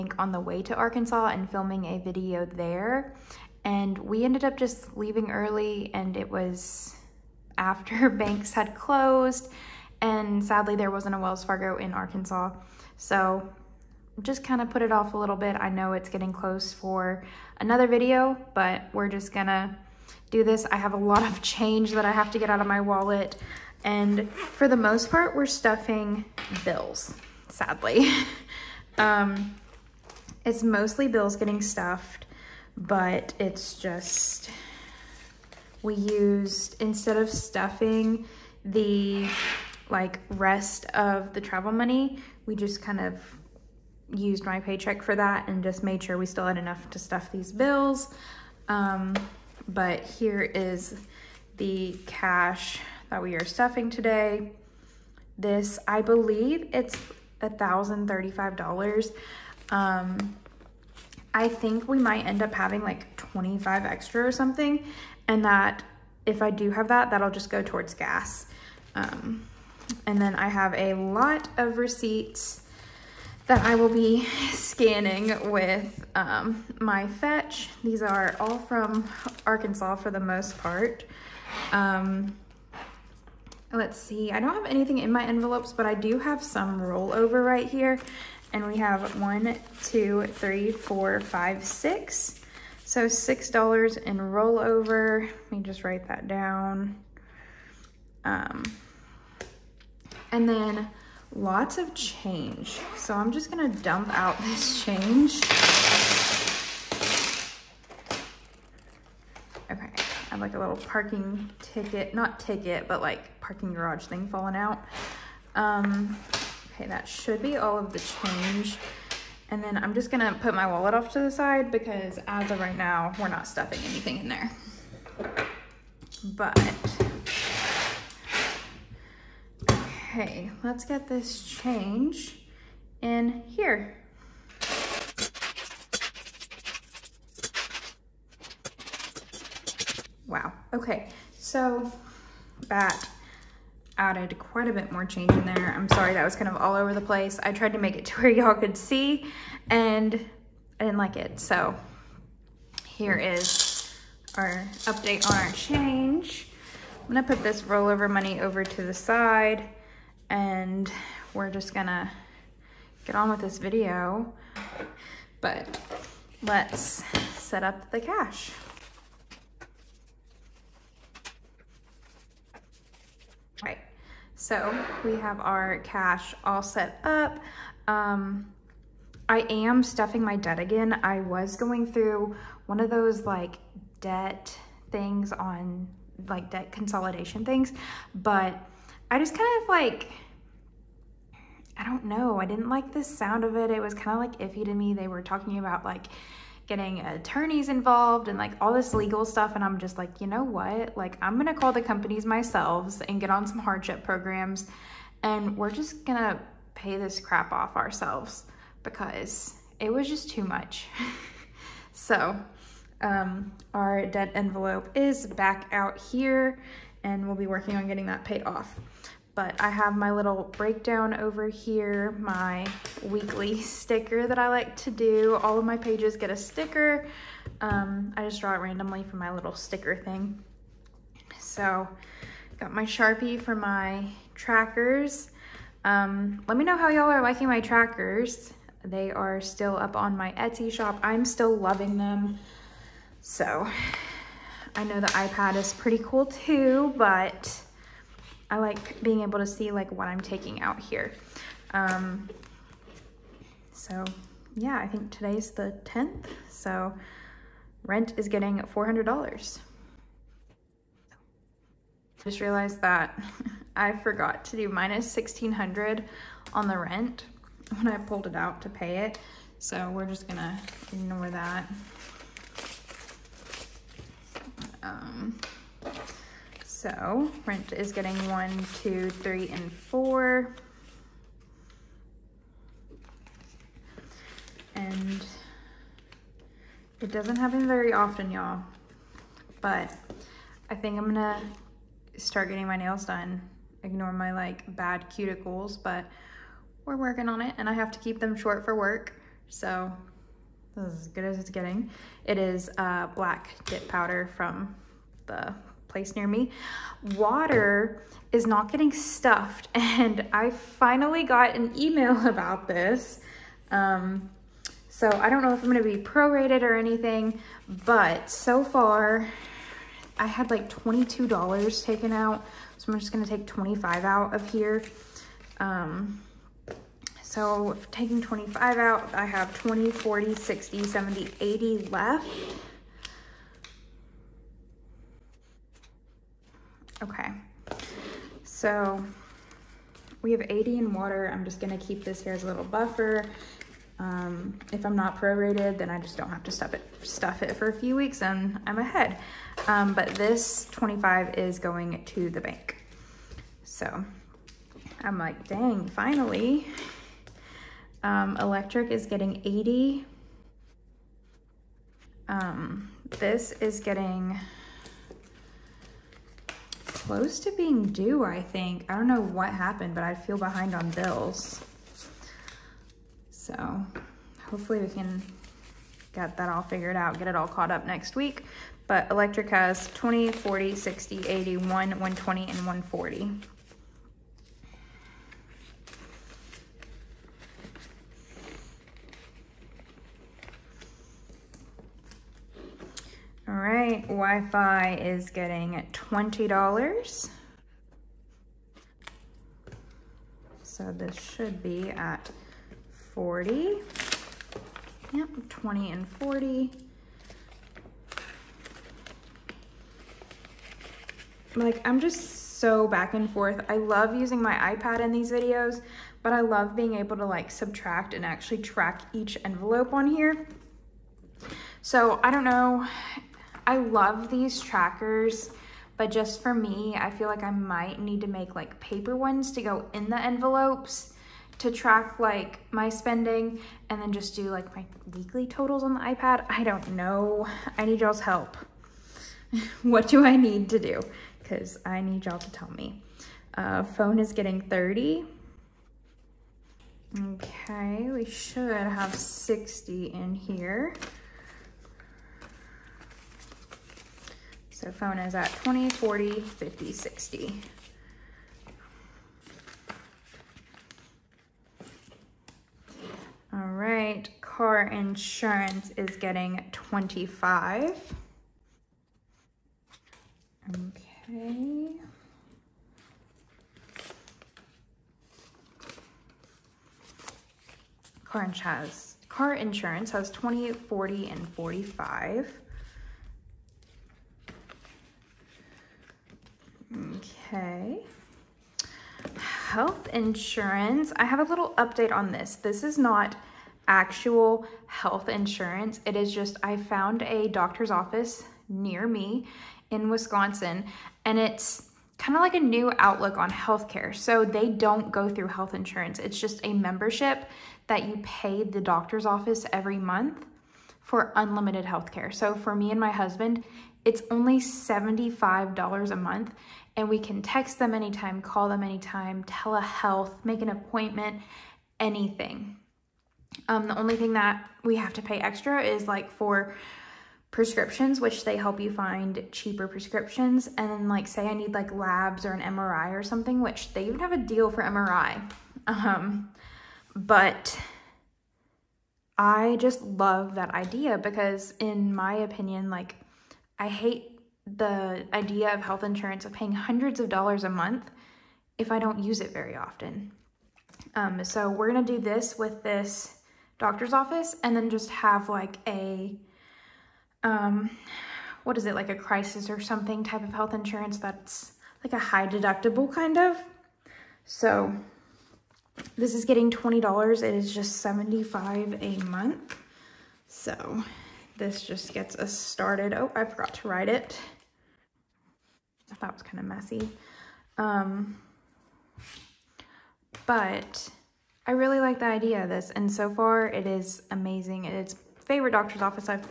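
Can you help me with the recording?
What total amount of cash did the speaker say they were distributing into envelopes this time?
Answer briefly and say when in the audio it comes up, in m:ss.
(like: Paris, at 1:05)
$1,035, at 0:57.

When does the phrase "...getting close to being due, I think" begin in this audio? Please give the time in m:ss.
6:03.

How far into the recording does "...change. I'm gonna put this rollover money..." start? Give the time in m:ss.
2:35.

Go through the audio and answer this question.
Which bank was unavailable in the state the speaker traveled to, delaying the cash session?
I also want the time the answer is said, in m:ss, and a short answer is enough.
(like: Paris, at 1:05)
Wells Fargo, at 0:11.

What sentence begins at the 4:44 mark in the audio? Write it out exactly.
And it doesn't happen very often, y'all.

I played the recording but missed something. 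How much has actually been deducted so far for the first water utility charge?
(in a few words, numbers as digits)
$22.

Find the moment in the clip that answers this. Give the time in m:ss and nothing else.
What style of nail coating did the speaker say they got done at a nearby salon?
5:03.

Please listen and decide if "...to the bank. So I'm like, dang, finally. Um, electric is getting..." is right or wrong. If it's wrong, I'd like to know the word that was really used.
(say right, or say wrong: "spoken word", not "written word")
right.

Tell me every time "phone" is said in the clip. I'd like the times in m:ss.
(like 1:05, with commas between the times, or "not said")
7:23, 7:34.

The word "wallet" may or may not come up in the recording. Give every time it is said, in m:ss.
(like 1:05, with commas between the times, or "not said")
0:22, 2:00.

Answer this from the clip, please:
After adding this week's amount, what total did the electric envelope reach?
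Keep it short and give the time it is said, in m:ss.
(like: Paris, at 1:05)
140, at 6:22.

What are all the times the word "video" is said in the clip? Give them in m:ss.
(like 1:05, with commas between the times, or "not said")
0:01, 0:17, 2:43, 6:55.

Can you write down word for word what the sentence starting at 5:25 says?
Um, so taking 25 out, I have 20, 40, 60, 70, 80 left.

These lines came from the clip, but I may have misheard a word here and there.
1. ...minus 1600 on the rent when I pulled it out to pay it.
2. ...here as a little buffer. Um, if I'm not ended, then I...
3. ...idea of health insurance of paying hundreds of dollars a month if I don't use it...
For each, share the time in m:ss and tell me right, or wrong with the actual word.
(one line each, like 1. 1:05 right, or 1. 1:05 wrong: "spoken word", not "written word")
1. 4:24 right
2. 5:42 wrong: "prorated", not "ended"
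3. 9:05 right.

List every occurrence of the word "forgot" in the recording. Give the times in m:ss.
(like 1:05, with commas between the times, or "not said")
4:24, 9:33.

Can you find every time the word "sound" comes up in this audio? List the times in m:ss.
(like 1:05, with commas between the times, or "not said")
3:13.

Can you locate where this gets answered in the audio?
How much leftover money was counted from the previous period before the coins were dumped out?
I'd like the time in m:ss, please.
1:33.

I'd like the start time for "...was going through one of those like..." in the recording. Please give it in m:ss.
3:01.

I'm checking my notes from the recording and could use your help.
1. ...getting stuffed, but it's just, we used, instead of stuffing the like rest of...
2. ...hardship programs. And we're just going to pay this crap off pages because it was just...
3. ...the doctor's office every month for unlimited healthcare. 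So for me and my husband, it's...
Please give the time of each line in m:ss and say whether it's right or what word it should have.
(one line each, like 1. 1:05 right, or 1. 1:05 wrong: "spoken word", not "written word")
1. 0:31 right
2. 3:23 wrong: "ourselves", not "pages"
3. 8:28 right.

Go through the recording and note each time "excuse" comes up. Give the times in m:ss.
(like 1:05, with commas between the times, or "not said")
not said.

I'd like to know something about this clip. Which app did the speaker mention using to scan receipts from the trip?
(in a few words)
Fetch.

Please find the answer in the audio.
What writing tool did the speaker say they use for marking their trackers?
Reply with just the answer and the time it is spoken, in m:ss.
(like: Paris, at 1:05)
Sharpie, at 3:52.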